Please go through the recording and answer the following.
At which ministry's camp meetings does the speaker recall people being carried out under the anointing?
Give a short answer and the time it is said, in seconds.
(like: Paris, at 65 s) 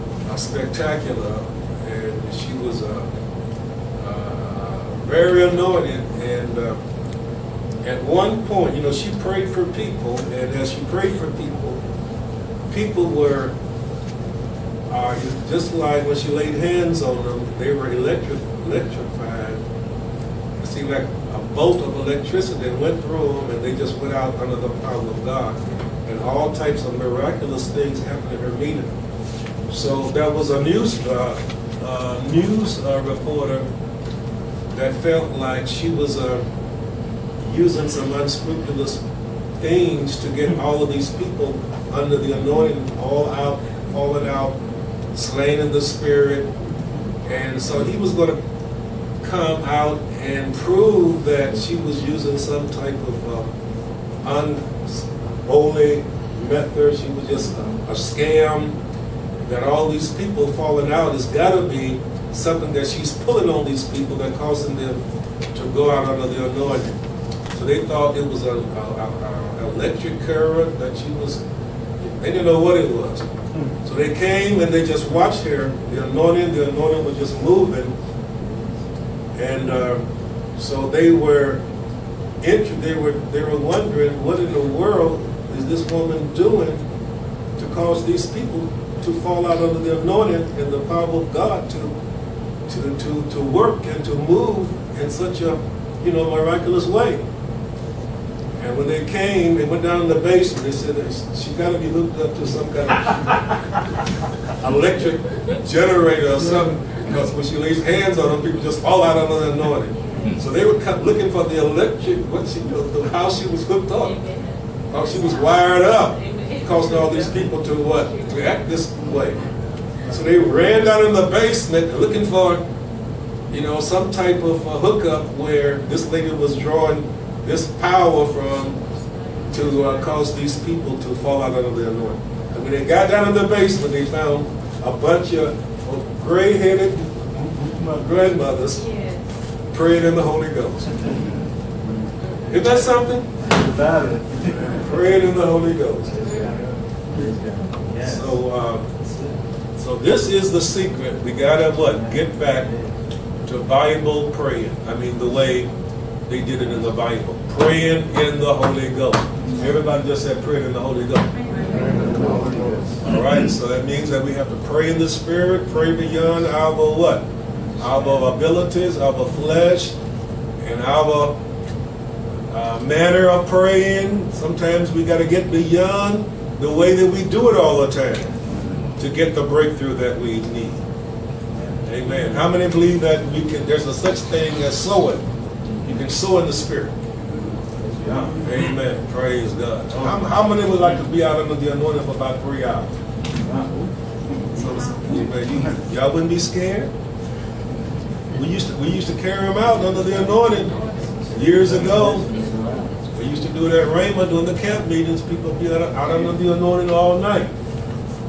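Rhema, at 203 s.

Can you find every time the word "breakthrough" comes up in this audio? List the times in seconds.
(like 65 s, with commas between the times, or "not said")
179 s.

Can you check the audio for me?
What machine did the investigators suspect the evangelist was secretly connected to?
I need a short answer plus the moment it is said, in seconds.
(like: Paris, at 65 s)
electric generator, at 104 s.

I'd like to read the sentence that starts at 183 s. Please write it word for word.
There's a such thing as sowing.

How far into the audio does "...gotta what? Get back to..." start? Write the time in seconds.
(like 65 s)
151 s.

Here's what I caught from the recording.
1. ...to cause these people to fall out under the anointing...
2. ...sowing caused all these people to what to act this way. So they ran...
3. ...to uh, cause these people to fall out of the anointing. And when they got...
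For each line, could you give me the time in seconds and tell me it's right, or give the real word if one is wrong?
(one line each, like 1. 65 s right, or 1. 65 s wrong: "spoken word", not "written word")
1. 87 s right
2. 116 s wrong: "causing", not "sowing"
3. 129 s right.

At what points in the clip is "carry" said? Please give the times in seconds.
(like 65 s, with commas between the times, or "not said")
199 s.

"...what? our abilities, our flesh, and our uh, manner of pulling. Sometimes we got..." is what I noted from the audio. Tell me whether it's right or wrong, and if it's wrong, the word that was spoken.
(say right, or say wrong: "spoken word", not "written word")
wrong: "praying", not "pulling".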